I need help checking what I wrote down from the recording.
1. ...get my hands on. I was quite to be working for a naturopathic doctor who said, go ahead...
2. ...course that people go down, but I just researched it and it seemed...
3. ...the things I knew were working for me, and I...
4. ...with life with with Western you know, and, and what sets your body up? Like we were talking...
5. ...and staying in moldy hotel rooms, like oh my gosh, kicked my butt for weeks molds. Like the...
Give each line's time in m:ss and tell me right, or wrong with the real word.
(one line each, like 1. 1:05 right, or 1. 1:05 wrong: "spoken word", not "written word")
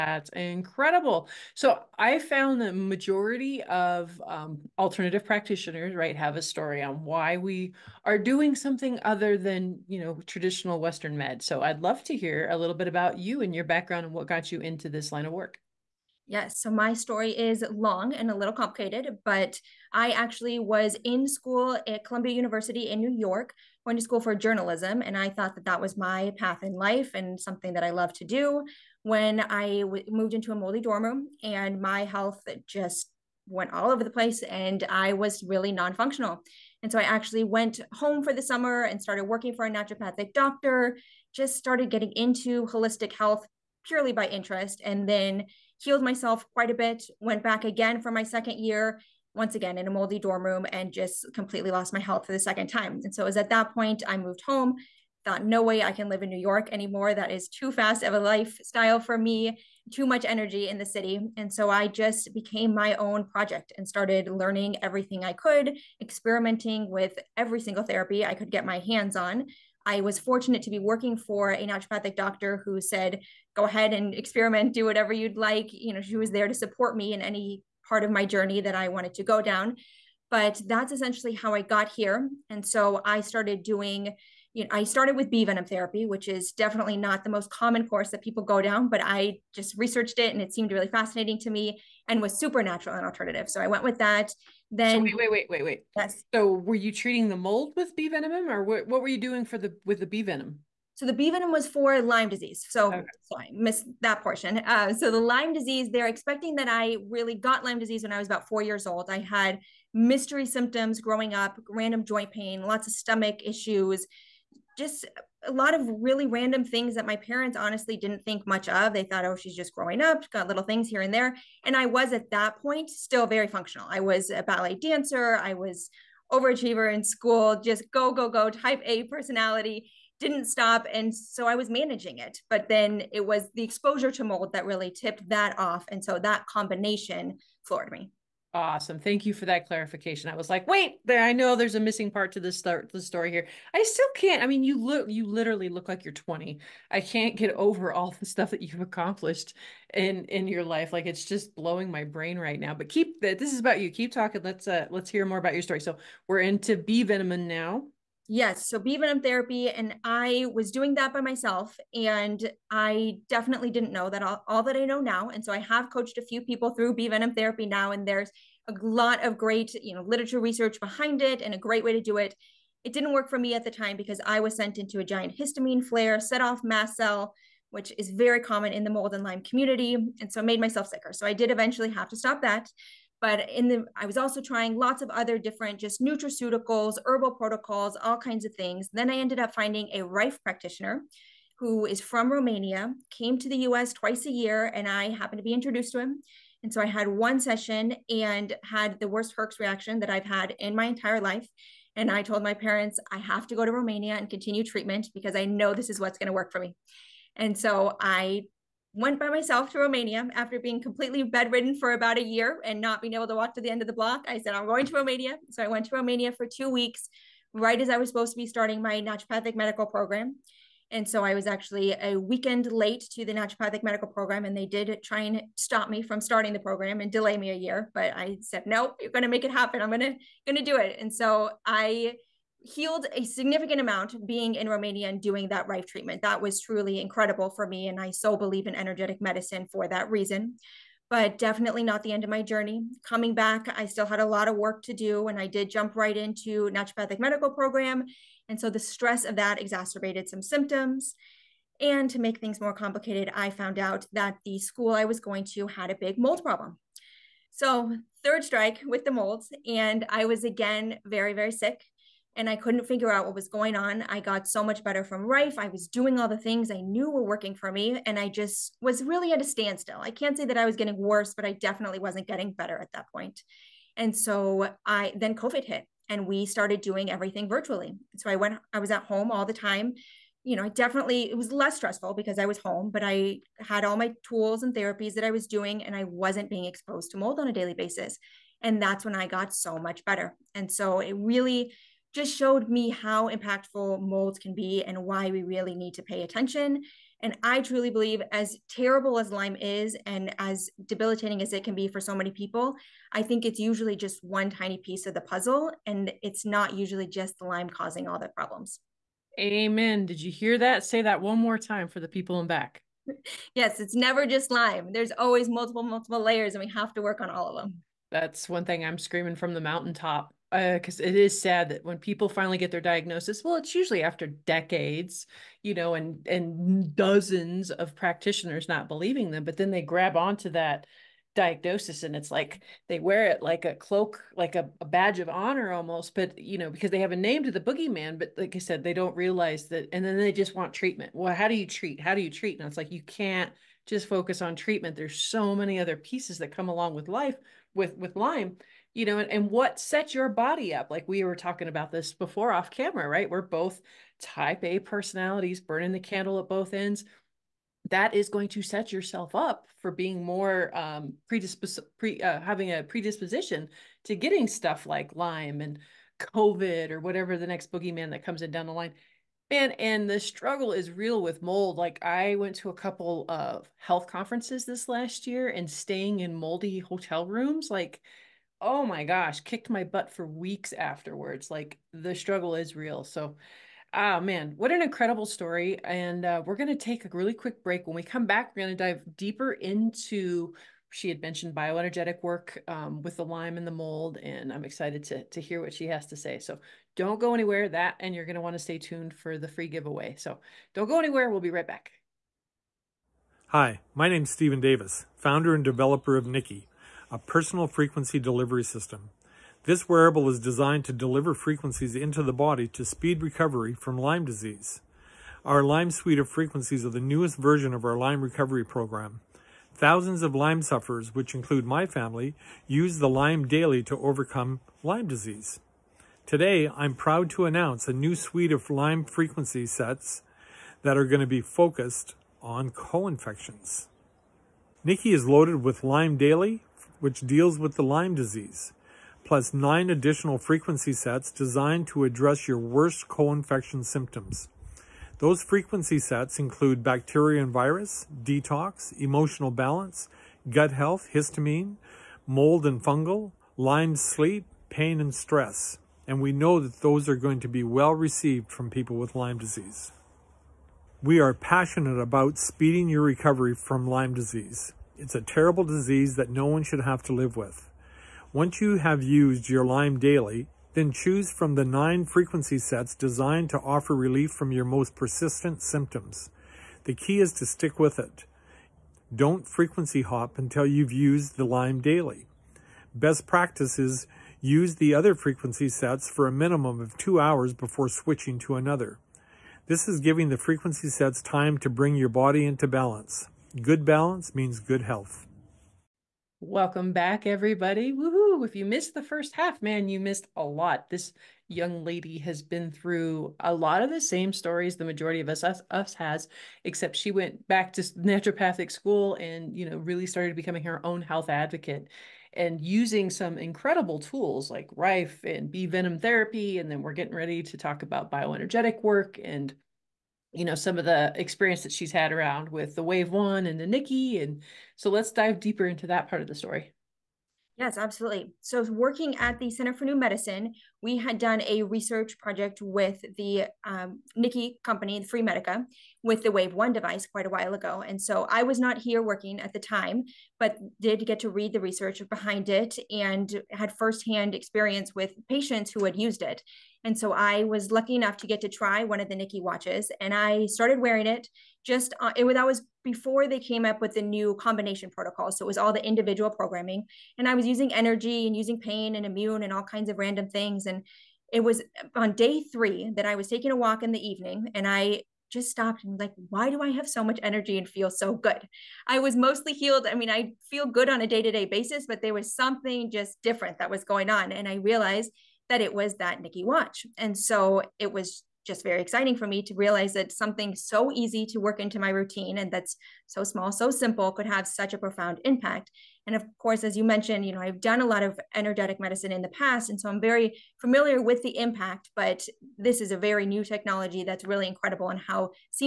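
1. 1:08 wrong: "fortunate", not "quite"
2. 1:27 right
3. 4:26 right
4. 5:46 wrong: "Lyme", not "Western"
5. 6:15 wrong: "afterwards", not "molds".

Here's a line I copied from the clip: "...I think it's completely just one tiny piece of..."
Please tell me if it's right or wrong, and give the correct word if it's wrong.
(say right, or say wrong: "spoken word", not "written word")
wrong: "usually", not "completely".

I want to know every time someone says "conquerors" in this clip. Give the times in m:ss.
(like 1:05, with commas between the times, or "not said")
not said.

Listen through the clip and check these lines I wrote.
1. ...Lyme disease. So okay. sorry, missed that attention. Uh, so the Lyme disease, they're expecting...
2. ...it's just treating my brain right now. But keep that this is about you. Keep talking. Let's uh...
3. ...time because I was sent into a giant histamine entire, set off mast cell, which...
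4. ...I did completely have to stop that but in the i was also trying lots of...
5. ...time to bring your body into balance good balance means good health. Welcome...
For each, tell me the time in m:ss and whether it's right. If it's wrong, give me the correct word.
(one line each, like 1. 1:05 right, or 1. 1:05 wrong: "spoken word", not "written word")
1. 1:41 wrong: "portion", not "attention"
2. 2:31 wrong: "blowing", not "treating"
3. 2:53 wrong: "flare", not "entire"
4. 3:01 wrong: "eventually", not "completely"
5. 8:11 right.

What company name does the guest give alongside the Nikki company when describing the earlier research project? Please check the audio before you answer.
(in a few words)
Freemedica.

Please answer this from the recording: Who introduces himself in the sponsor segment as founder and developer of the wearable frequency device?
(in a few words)
Stephen Davis.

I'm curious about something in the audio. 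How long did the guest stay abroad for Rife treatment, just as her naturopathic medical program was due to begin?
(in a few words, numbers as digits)
2 weeks.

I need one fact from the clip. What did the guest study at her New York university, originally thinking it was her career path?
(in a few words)
Journalism.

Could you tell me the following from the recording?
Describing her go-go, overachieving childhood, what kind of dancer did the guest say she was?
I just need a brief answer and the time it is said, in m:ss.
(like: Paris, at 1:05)
Ballet dancer, at 2:04.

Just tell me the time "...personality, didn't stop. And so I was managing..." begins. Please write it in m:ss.
2:09.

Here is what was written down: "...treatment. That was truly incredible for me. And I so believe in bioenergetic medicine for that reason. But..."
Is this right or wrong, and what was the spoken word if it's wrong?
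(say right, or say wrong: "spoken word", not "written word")
wrong: "energetic", not "bioenergetic".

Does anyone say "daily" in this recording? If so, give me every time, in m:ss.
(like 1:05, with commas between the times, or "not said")
4:47, 7:03, 7:16, 7:49, 8:01.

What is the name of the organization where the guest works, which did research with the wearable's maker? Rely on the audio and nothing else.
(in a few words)
Center for New Medicine.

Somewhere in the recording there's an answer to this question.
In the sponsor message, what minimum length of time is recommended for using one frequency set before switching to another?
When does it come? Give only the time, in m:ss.
8:06.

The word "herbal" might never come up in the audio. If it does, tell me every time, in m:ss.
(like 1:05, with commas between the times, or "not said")
3:07.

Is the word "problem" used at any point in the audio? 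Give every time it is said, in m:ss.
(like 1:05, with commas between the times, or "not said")
4:16, 5:08.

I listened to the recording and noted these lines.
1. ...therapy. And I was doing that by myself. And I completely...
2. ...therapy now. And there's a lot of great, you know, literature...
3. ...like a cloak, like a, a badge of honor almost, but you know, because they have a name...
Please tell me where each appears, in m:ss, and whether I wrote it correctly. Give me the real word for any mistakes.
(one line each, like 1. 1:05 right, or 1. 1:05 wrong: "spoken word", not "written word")
1. 2:39 wrong: "definitely", not "completely"
2. 2:47 right
3. 5:33 right.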